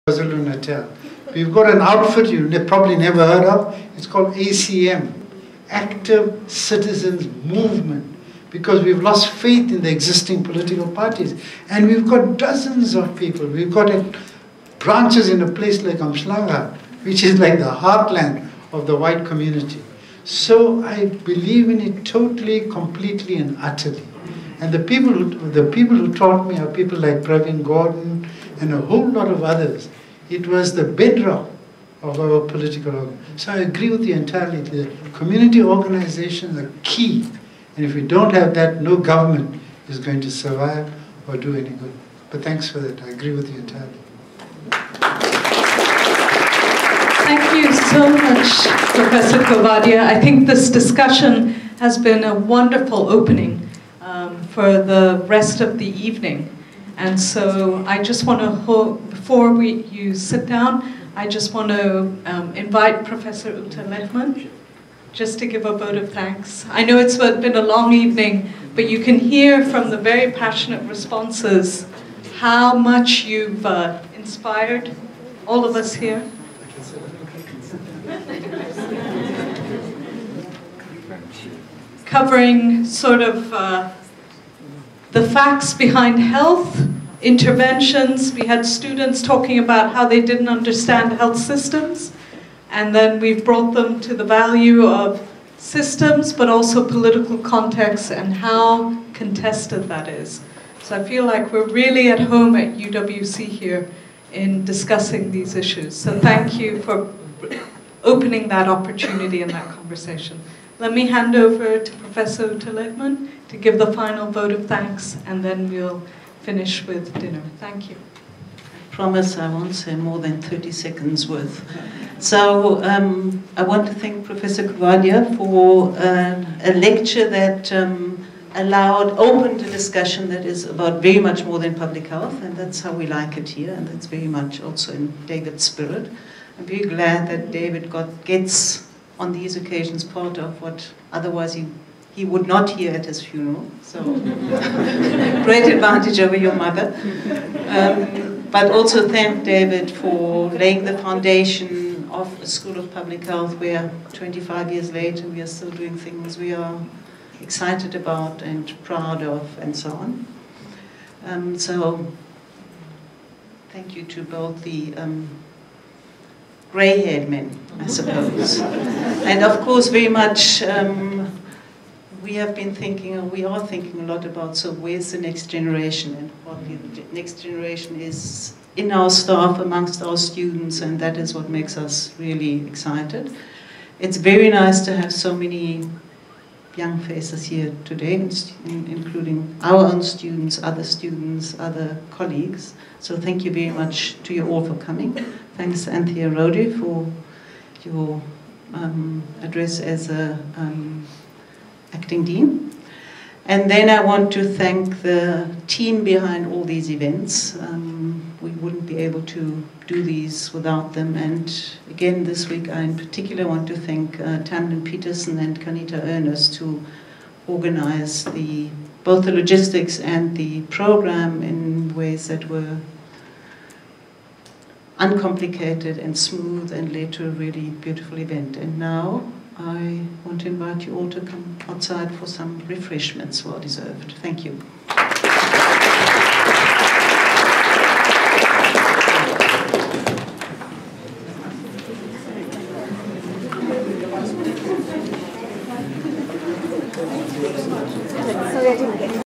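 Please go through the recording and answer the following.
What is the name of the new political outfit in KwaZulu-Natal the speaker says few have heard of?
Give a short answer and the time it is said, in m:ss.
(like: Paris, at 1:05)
Active Citizens Movement, at 0:05.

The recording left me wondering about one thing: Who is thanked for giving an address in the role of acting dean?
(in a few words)
Anthea Rodi.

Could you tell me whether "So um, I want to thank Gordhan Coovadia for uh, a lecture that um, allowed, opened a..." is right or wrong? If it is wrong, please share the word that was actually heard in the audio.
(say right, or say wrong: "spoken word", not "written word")
wrong: "Professor", not "Gordhan".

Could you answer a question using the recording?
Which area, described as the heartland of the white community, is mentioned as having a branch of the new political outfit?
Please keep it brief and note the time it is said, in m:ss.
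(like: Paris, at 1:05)
Umhlanga, at 0:15.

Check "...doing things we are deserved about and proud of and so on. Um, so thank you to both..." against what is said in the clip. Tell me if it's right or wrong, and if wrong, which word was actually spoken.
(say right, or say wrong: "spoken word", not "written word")
wrong: "excited", not "deserved".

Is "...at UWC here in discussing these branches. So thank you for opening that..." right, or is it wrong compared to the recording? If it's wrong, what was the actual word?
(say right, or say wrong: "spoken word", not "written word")
wrong: "issues", not "branches".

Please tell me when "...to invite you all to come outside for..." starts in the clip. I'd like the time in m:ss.
3:50.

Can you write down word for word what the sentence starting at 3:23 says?
And then I want to thank the team behind all these events.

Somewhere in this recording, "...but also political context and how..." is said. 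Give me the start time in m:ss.
1:36.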